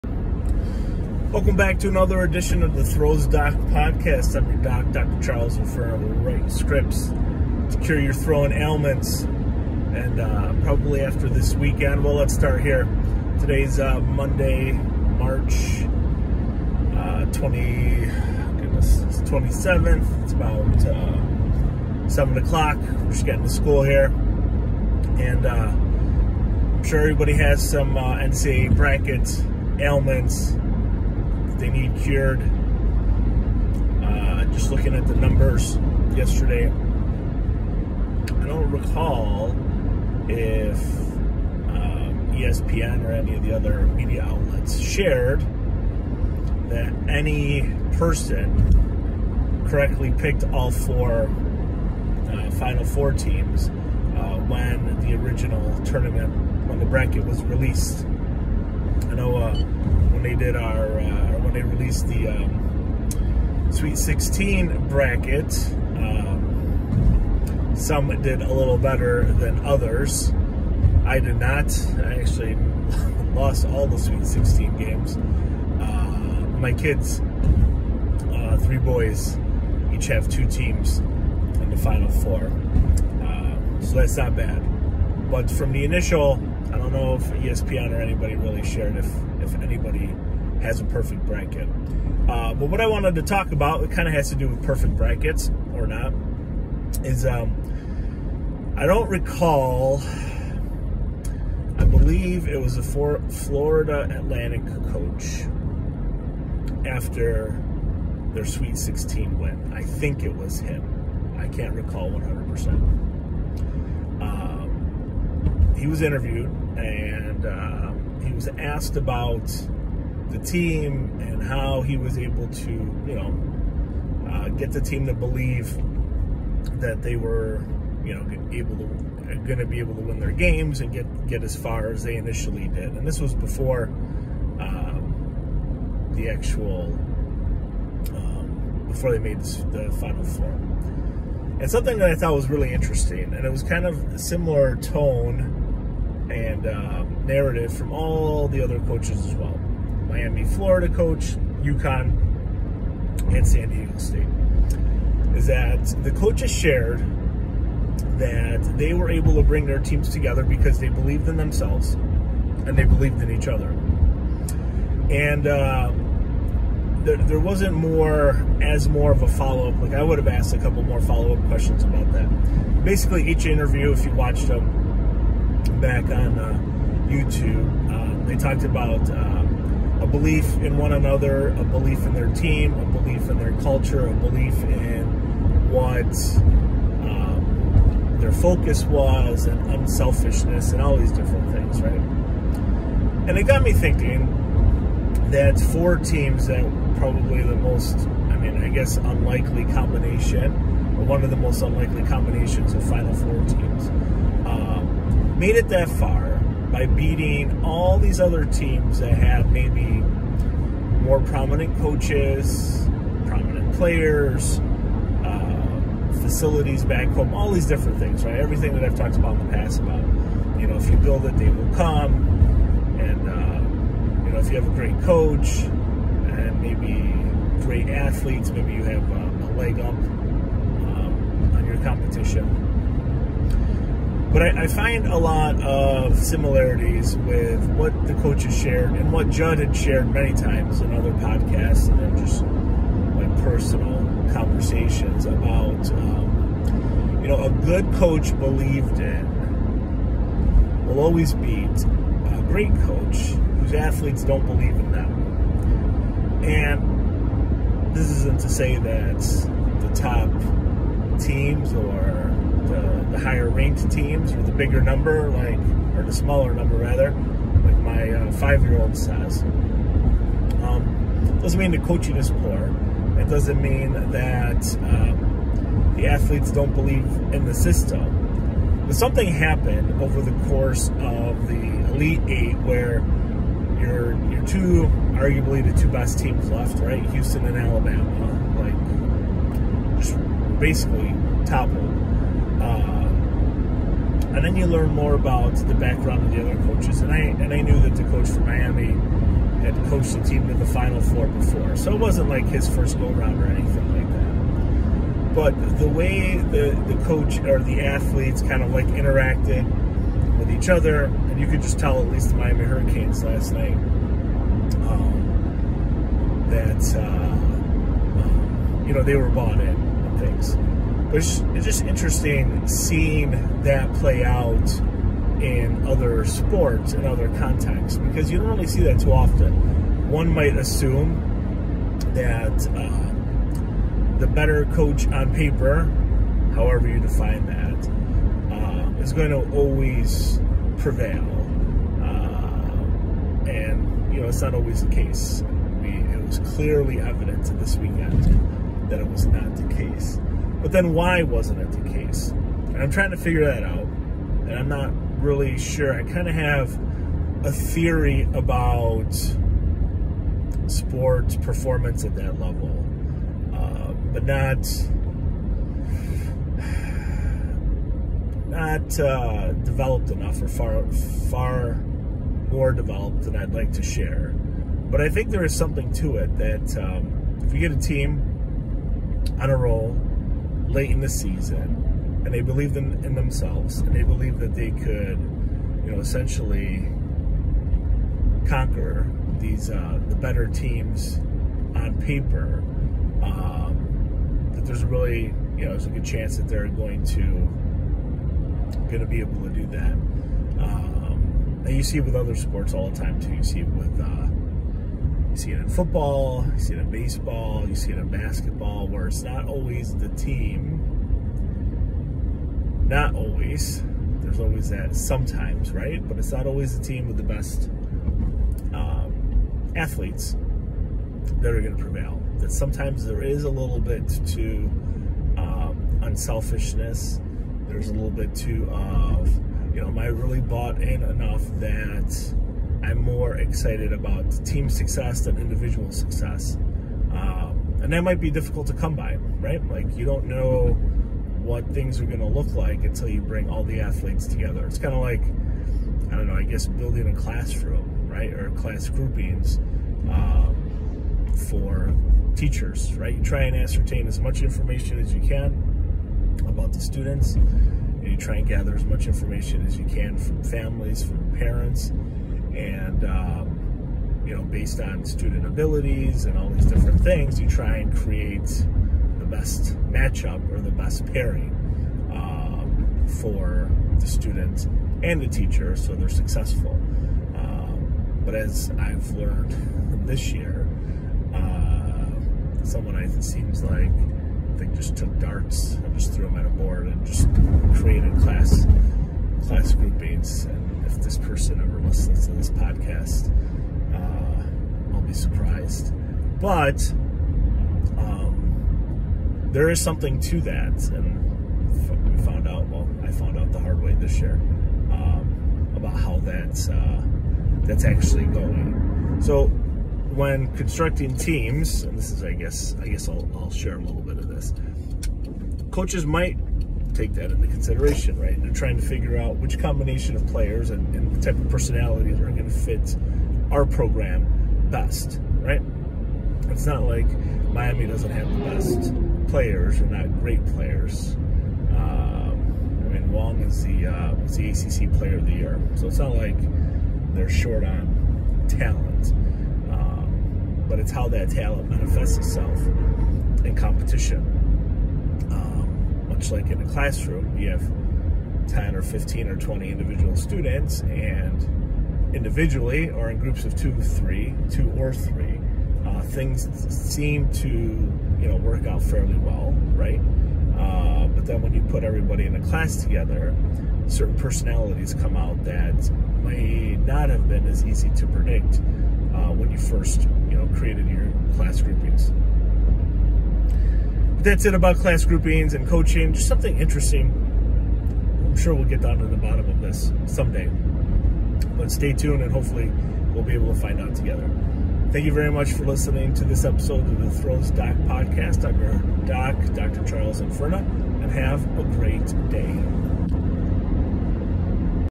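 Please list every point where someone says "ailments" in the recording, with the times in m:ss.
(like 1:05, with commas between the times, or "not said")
0:08, 0:29.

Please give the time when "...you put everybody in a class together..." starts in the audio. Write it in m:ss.
9:21.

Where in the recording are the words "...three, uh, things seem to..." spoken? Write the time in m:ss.
9:14.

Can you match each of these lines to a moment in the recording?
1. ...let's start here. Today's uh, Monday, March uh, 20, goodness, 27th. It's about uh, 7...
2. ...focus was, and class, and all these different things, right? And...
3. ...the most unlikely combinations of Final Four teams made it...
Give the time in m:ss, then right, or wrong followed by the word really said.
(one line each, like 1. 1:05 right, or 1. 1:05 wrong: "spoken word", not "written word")
1. 0:12 right
2. 3:08 wrong: "unselfishness", not "class"
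3. 3:21 right.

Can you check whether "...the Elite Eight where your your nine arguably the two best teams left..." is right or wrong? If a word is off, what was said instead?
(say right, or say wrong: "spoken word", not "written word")
wrong: "two", not "nine".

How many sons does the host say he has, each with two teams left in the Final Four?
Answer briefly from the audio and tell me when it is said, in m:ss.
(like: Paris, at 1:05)
3, at 1:18.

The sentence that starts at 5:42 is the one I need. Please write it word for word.
Uh, and, you know, it's not always the case.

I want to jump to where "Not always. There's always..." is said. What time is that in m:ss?
6:52.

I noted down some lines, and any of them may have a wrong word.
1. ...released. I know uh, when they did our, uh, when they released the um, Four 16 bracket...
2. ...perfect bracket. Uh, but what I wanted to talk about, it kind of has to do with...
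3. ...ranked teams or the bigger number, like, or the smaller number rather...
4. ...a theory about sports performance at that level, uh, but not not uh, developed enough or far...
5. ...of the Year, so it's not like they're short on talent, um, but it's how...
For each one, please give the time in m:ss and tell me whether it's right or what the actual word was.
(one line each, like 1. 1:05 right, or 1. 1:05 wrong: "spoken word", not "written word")
1. 0:57 wrong: "Sweet", not "Four"
2. 1:30 right
3. 4:23 right
4. 5:57 right
5. 8:55 right.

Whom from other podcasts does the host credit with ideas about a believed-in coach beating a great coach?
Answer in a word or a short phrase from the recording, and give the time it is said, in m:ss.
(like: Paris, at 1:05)
Judd, at 3:59.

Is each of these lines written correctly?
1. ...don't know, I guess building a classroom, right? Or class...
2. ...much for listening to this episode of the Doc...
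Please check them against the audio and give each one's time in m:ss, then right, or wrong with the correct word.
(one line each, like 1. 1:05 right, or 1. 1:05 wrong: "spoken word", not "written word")
1. 7:26 right
2. 9:45 wrong: "Throws", not "Doc".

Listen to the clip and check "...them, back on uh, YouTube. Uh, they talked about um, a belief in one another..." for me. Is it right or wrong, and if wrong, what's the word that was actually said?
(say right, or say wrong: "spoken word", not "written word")
right.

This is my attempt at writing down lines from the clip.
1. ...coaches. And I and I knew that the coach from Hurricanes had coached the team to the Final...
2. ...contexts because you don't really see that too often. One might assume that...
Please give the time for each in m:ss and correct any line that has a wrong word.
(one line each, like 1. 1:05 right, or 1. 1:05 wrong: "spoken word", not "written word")
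1. 4:56 wrong: "Miami", not "Hurricanes"
2. 5:27 right.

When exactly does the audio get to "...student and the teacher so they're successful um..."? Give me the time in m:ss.
7:54.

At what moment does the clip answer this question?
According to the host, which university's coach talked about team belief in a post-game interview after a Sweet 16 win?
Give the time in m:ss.
1:43.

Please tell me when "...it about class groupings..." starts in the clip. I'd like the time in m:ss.
9:34.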